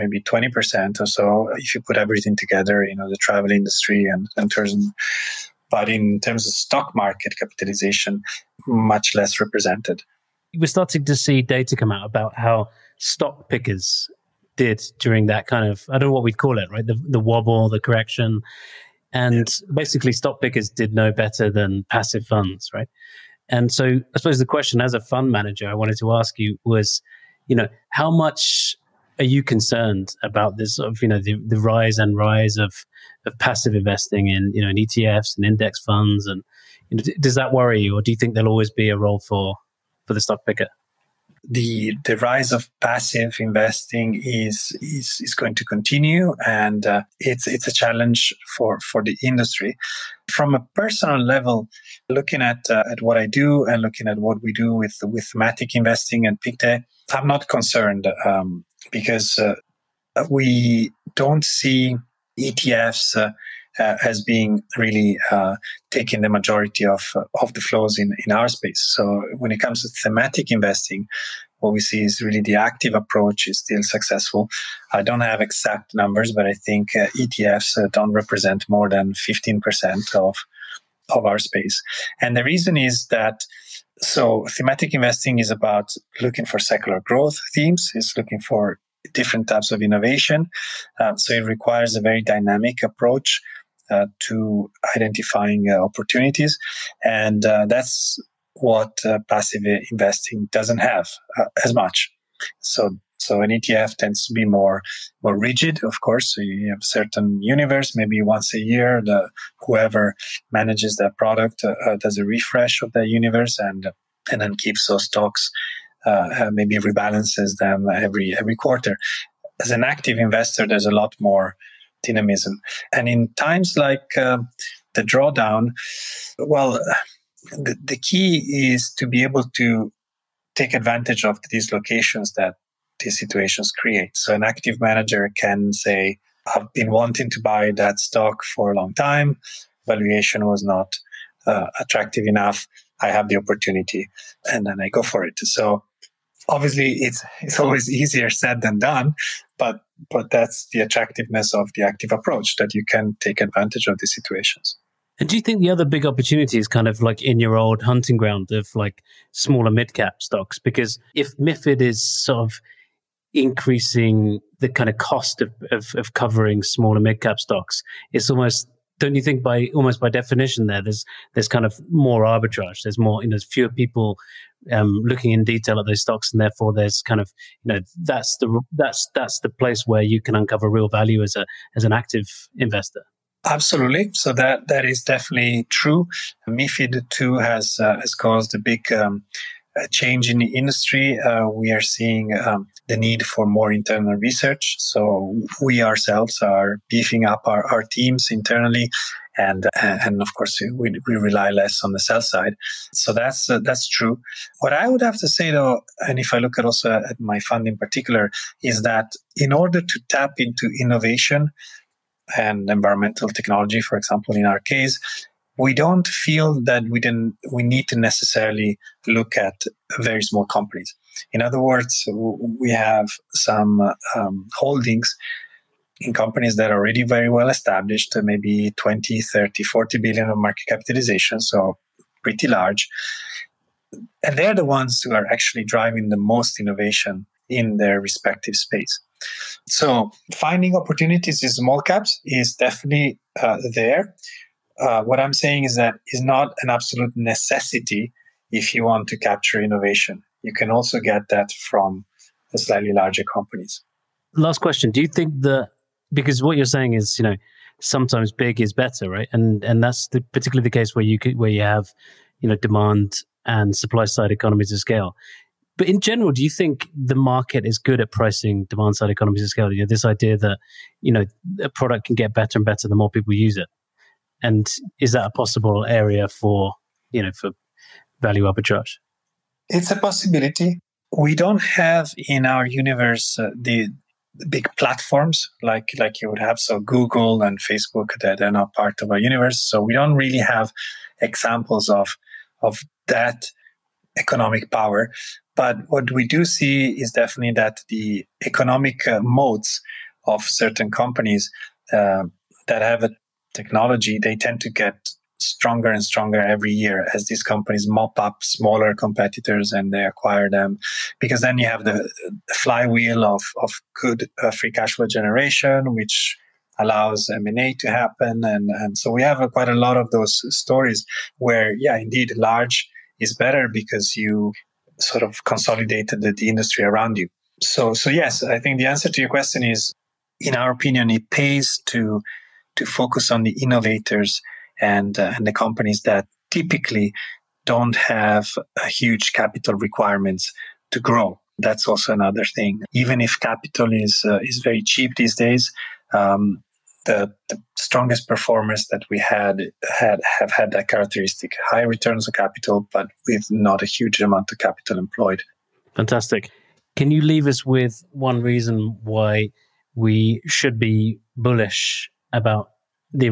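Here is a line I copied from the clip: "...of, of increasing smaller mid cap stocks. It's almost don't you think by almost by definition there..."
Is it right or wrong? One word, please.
wrong.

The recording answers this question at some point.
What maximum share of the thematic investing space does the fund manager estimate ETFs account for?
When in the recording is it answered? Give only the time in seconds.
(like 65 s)
79 s.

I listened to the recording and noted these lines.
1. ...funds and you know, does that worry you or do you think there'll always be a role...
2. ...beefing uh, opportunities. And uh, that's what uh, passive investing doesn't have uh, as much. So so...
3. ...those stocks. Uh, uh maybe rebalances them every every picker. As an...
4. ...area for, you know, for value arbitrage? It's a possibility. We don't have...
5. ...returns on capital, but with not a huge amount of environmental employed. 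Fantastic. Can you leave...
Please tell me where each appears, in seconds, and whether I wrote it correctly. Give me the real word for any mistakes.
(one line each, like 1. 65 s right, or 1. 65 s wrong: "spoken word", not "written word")
1. 35 s right
2. 94 s wrong: "identifying", not "beefing"
3. 114 s wrong: "quarter", not "picker"
4. 275 s right
5. 351 s wrong: "capital", not "environmental".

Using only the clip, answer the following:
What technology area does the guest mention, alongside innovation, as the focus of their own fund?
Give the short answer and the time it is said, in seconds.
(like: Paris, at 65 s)
Environmental technology, at 212 s.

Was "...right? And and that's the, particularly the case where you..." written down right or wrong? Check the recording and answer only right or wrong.
right.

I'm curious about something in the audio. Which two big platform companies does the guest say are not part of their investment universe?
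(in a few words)
Google and Facebook.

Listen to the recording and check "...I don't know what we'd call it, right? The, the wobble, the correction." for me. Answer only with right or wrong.
right.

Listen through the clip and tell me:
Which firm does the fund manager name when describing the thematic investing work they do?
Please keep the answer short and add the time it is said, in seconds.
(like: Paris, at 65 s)
Pictet, at 56 s.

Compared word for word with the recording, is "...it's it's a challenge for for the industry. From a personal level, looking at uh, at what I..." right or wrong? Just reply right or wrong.
right.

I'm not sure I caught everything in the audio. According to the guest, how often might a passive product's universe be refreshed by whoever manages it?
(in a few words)
Once a year.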